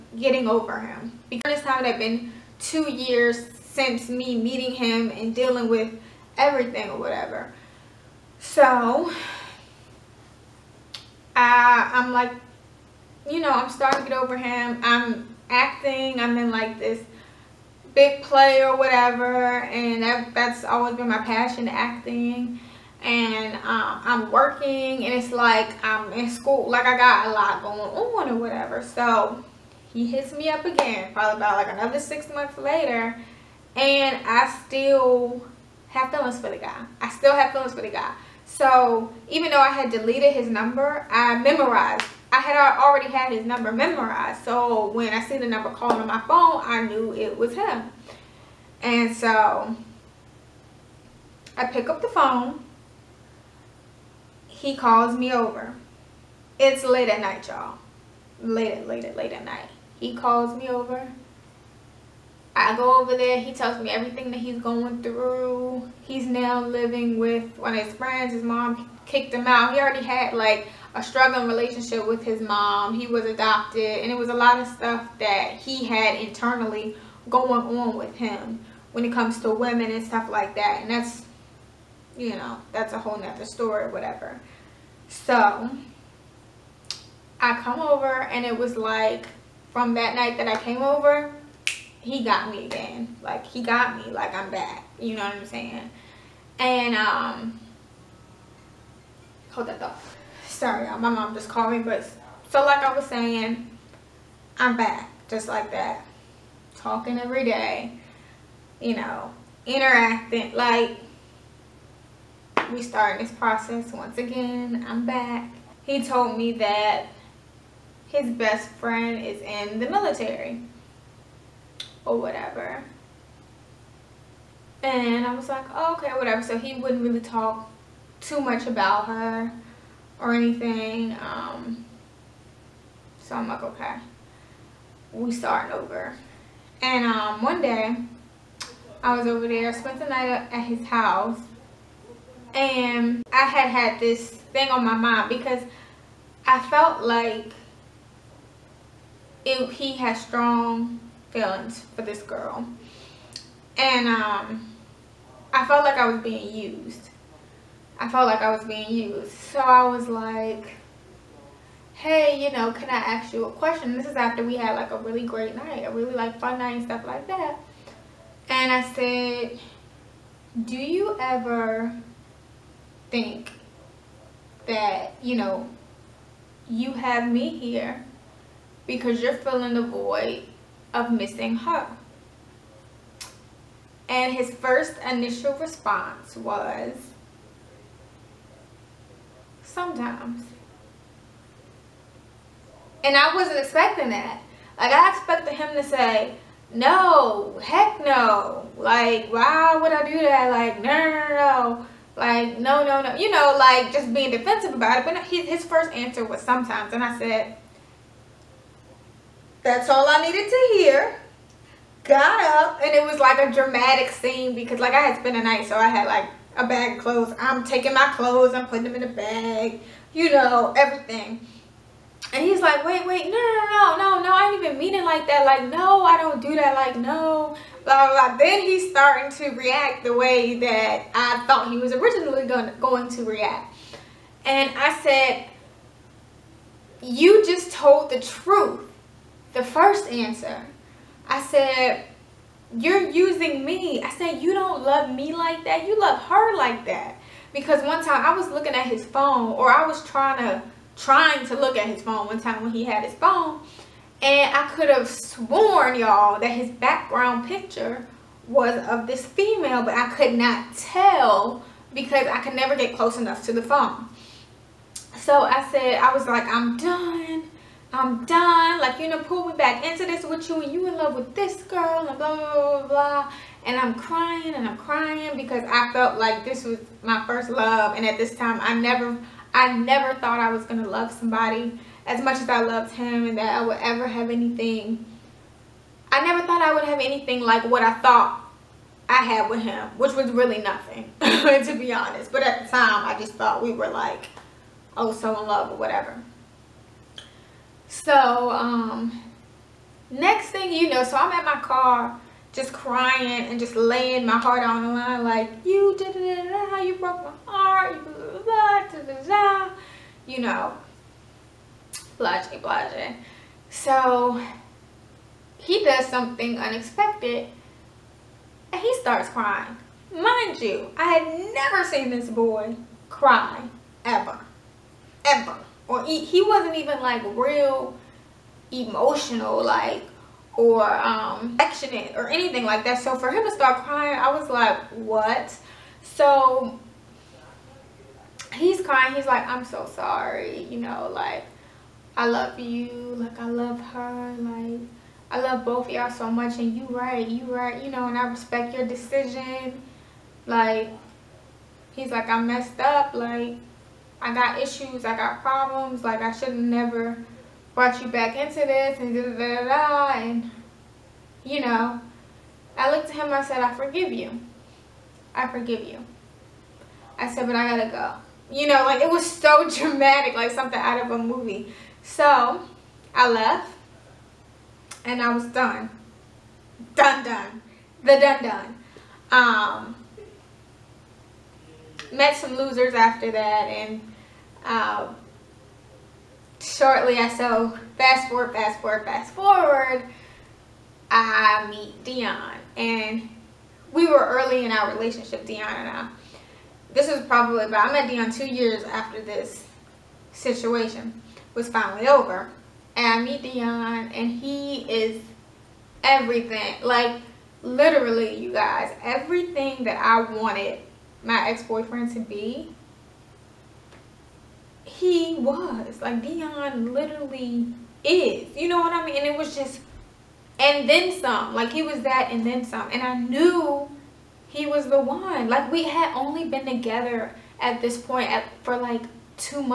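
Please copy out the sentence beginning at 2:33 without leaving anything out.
And um, I felt like I was being used.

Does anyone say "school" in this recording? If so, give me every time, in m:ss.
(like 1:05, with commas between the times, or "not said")
0:26.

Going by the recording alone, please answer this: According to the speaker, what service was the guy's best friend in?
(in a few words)
The military.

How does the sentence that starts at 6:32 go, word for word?
And we were early in our relationship, Dion and I.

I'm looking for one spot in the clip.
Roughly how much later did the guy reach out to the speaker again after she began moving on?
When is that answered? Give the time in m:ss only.
0:31.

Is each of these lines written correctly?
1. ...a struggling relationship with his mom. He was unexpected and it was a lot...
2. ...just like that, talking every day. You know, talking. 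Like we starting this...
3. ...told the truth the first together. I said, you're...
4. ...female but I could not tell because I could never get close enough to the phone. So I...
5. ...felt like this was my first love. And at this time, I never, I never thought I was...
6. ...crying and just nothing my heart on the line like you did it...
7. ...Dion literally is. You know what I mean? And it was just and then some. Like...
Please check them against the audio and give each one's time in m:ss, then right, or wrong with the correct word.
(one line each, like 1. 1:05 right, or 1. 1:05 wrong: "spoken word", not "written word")
1. 1:10 wrong: "adopted", not "unexpected"
2. 1:45 wrong: "interacting", not "talking"
3. 3:57 wrong: "answer", not "together"
4. 4:19 right
5. 4:35 right
6. 5:02 wrong: "laying", not "nothing"
7. 6:56 right.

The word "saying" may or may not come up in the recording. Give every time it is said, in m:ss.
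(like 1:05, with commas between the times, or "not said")
1:35, 1:43.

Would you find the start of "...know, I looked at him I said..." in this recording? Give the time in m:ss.
6:01.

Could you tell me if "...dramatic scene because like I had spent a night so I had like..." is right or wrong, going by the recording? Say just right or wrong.
right.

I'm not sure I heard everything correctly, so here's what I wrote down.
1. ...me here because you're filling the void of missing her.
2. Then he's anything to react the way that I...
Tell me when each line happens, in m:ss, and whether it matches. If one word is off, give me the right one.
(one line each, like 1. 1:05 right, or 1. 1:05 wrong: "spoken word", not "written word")
1. 2:57 right
2. 3:48 wrong: "starting", not "anything".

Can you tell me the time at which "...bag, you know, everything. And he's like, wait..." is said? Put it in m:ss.
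3:39.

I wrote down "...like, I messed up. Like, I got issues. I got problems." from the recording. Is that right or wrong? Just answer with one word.
right.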